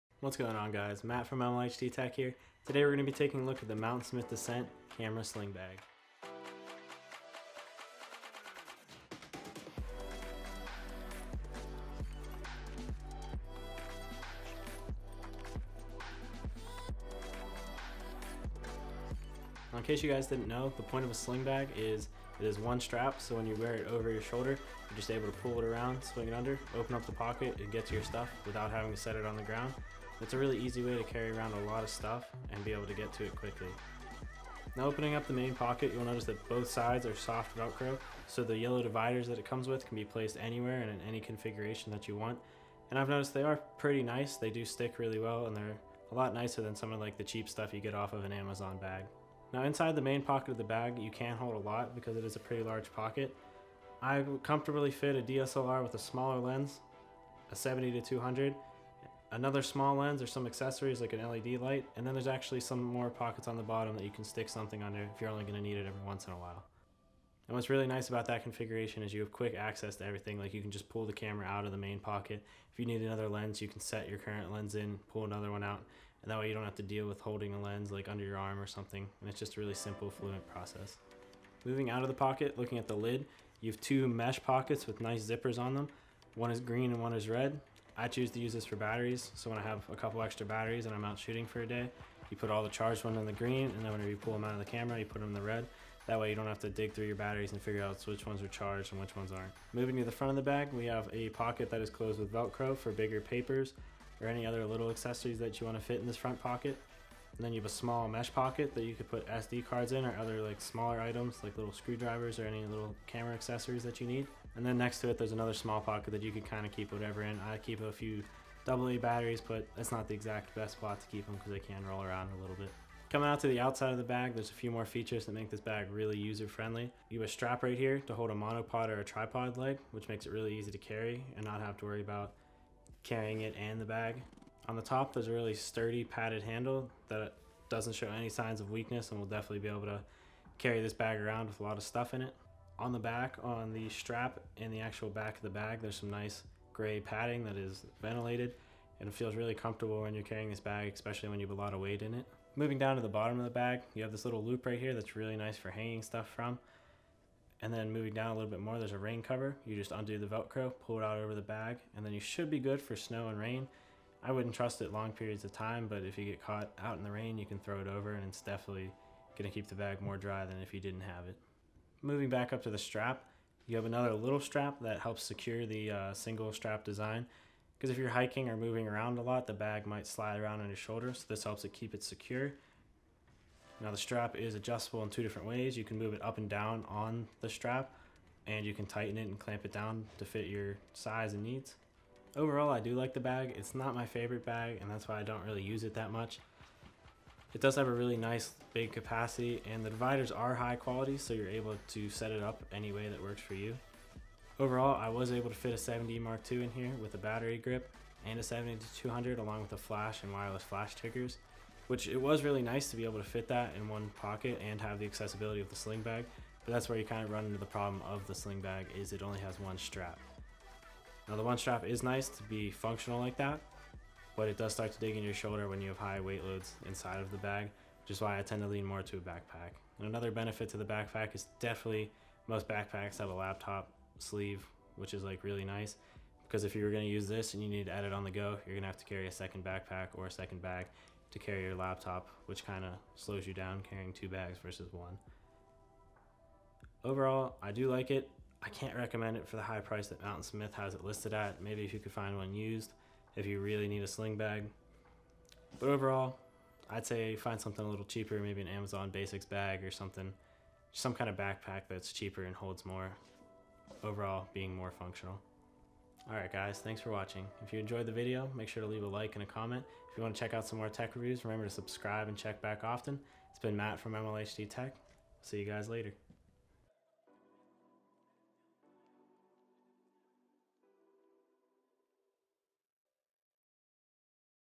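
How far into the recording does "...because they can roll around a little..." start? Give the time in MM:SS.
02:01.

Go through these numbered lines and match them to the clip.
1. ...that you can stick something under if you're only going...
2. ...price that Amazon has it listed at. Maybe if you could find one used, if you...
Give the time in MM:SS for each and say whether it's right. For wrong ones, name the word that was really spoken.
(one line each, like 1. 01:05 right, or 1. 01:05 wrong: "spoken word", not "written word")
1. 01:03 right
2. 04:09 wrong: "Mountainsmith", not "Amazon".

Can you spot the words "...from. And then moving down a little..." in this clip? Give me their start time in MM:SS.
02:36.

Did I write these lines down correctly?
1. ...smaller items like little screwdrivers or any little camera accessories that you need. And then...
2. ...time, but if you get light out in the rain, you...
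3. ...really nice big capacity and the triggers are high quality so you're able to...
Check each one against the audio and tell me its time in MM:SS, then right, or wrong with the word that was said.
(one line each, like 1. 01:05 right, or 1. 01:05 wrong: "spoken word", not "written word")
1. 01:50 right
2. 02:45 wrong: "caught", not "light"
3. 03:17 wrong: "dividers", not "triggers".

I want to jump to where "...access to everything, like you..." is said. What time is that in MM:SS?
01:09.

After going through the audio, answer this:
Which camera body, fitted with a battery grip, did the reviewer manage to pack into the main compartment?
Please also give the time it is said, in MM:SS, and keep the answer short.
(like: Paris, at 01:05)
7D Mark II, at 03:25.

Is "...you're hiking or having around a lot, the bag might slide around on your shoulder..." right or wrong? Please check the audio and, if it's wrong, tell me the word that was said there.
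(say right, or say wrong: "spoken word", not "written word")
wrong: "moving", not "having".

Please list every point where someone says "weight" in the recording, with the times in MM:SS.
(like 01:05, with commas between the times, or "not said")
02:31, 03:46.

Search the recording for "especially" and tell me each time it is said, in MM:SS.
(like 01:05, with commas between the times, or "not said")
02:30.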